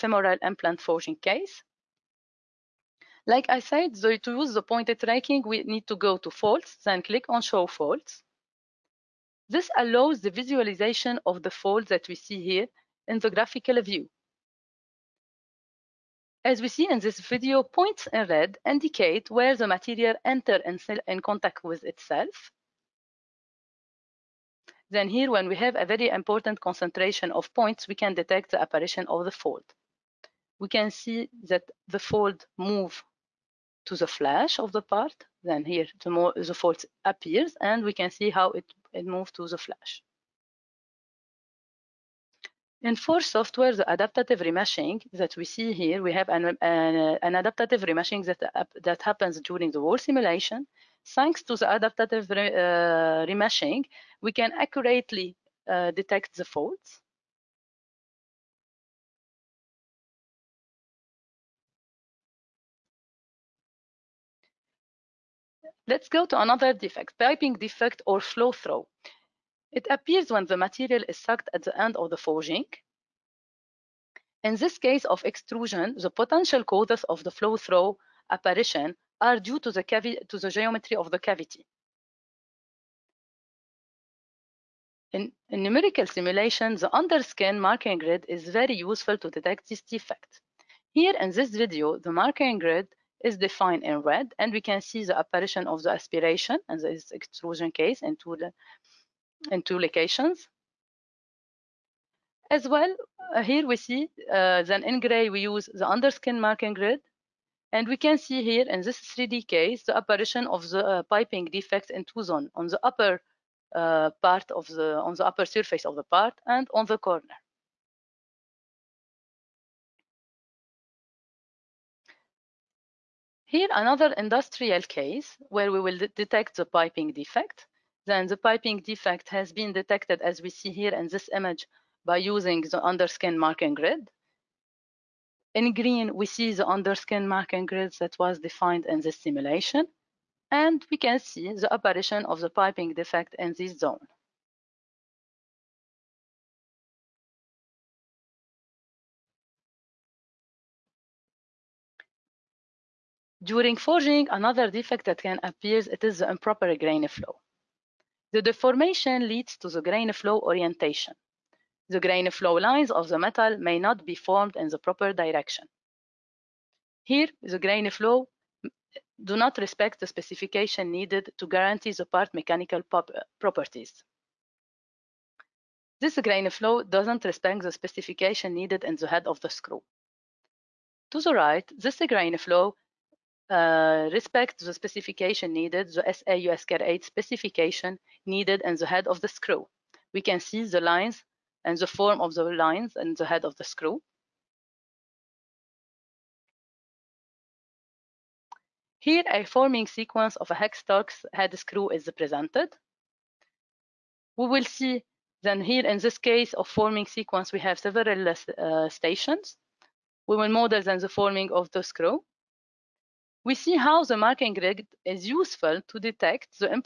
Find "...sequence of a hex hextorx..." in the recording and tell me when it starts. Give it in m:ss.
3:19.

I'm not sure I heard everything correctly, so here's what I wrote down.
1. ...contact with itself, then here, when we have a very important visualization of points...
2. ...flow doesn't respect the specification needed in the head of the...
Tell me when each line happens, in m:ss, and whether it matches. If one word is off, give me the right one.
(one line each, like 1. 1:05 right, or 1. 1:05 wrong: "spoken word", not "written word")
1. 0:21 wrong: "concentration", not "visualization"
2. 2:56 right.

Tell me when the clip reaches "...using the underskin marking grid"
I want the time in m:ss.
2:12.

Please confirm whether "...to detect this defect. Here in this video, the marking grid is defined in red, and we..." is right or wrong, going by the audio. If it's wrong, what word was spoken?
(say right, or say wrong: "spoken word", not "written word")
right.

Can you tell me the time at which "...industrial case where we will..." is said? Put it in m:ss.
2:04.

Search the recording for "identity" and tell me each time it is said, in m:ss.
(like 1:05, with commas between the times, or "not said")
not said.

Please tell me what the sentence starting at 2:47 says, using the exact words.
Here, the grain flow mm, do not respect the specification needed to guarantee the part mechanical uh, properties.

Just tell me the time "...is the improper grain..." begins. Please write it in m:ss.
2:36.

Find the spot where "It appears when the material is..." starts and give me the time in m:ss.
1:09.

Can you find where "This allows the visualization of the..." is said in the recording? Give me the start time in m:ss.
0:09.